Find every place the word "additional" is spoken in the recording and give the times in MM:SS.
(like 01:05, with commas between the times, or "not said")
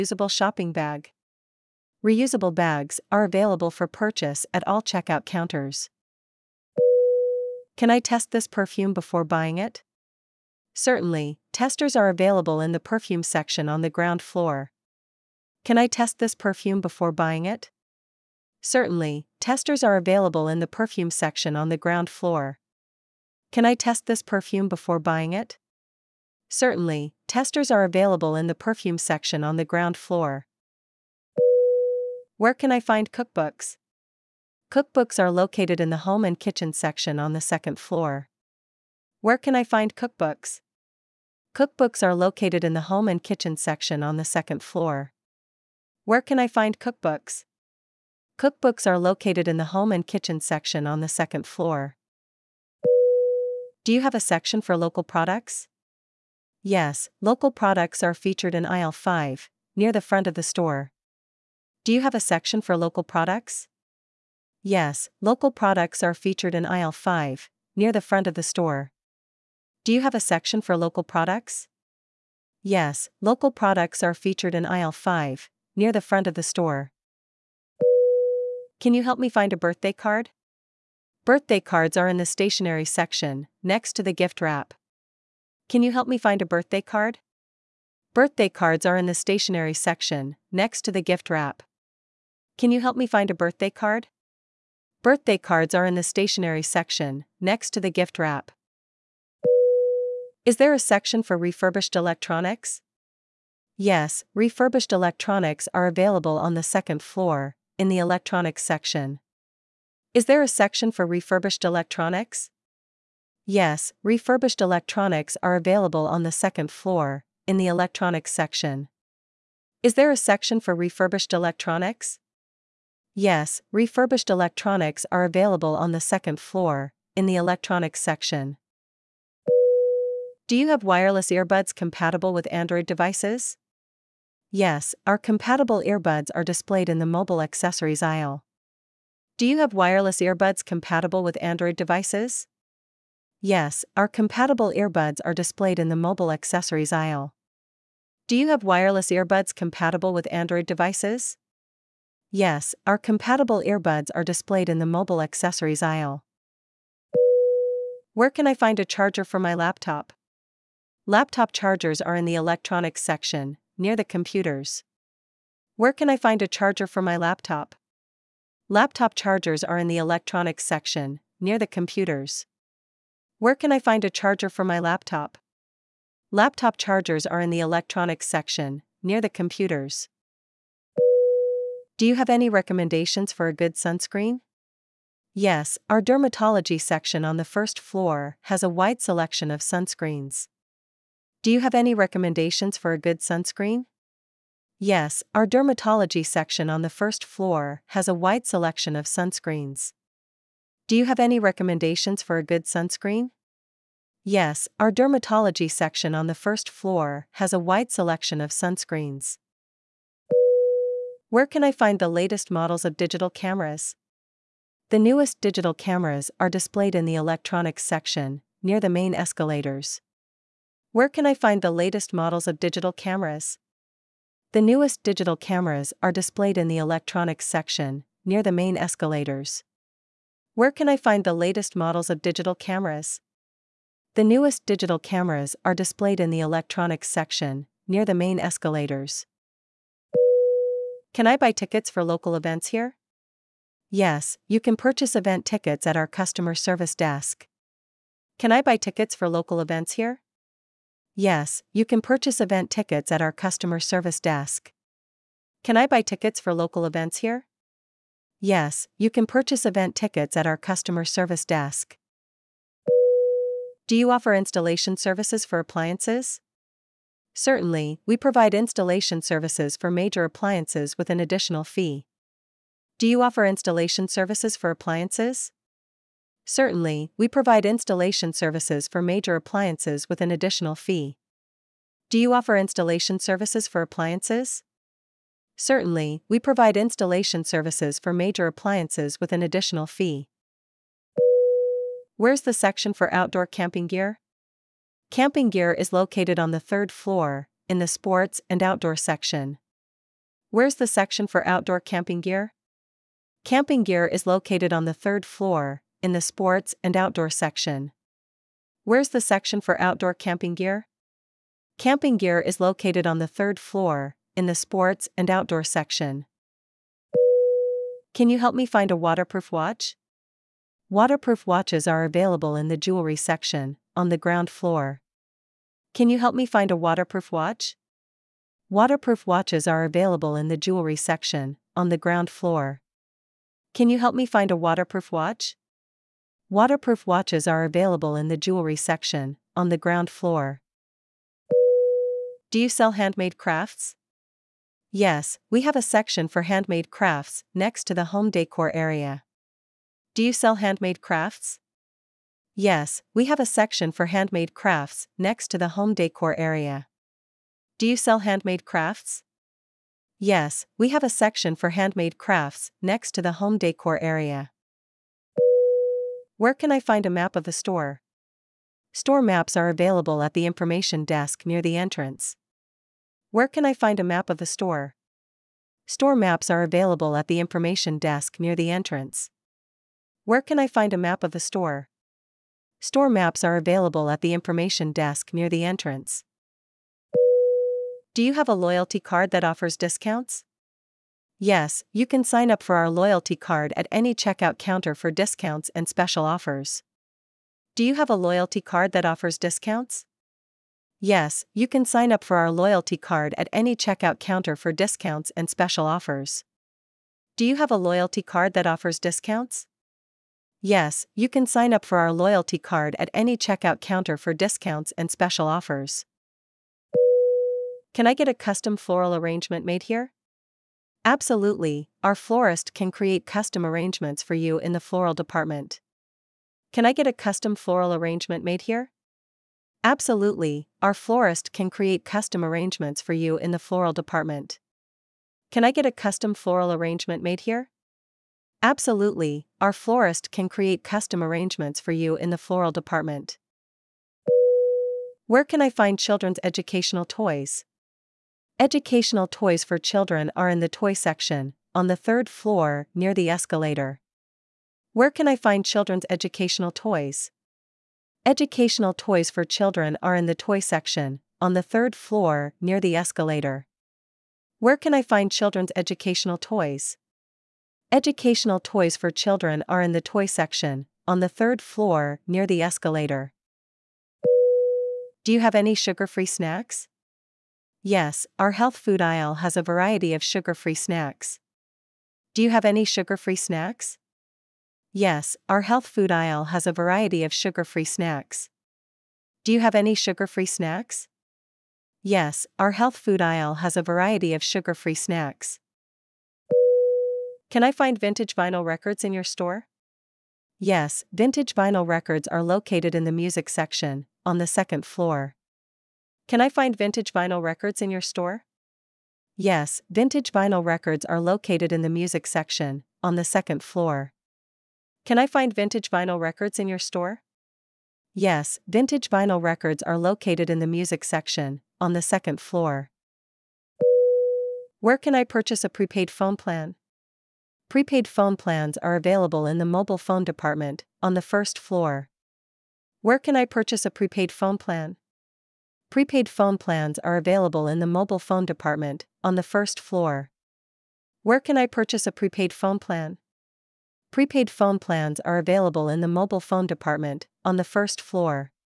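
04:31, 04:40, 04:49.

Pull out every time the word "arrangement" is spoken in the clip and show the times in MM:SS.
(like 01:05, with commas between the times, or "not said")
06:59, 07:03, 07:07, 07:12, 07:16, 07:21.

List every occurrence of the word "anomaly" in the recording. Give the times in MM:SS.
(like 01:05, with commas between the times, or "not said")
not said.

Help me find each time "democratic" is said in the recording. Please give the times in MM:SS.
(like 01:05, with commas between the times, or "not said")
not said.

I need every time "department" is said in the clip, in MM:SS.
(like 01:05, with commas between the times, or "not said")
07:05, 07:13, 07:22, 08:50, 08:58, 09:06.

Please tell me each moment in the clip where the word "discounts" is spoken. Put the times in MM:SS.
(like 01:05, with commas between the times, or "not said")
06:29, 06:35, 06:39, 06:44, 06:48, 06:54.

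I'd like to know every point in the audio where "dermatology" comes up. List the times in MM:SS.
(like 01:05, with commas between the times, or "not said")
03:06, 03:15, 03:24.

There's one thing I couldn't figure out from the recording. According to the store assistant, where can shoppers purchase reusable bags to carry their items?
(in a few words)
At all checkout counters.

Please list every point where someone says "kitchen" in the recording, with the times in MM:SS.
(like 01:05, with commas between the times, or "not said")
00:36, 00:43, 00:50.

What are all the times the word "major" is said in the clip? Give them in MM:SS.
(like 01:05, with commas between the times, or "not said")
04:29, 04:39, 04:48.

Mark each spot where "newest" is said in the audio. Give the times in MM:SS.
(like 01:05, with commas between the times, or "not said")
03:34, 03:44, 03:54.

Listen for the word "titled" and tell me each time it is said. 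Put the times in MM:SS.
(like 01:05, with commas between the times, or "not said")
not said.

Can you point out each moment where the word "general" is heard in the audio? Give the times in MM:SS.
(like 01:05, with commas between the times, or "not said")
not said.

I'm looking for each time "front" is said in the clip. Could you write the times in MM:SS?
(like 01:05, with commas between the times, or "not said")
01:00, 01:08, 01:16.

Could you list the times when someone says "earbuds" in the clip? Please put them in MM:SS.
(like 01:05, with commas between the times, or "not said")
02:11, 02:15, 02:20, 02:24, 02:29, 02:33.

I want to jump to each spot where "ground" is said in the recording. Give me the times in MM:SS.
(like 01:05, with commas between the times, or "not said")
00:13, 00:21, 00:29, 05:24, 05:31, 05:39.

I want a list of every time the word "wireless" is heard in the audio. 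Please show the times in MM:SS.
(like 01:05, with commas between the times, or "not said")
02:10, 02:19, 02:28.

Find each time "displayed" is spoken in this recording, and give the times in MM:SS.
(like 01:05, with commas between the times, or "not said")
02:16, 02:25, 02:34, 03:36, 03:46, 03:55.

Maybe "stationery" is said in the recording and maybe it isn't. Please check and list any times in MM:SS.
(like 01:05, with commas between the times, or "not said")
01:22, 01:29, 01:36.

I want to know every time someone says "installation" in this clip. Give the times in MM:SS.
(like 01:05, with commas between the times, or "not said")
04:24, 04:28, 04:33, 04:37, 04:42, 04:46.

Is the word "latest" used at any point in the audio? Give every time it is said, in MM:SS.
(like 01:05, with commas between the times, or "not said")
03:32, 03:41, 03:51.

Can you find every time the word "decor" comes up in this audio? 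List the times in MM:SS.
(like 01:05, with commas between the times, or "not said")
05:48, 05:55, 06:03.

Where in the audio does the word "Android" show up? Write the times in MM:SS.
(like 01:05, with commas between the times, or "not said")
02:12, 02:21, 02:30.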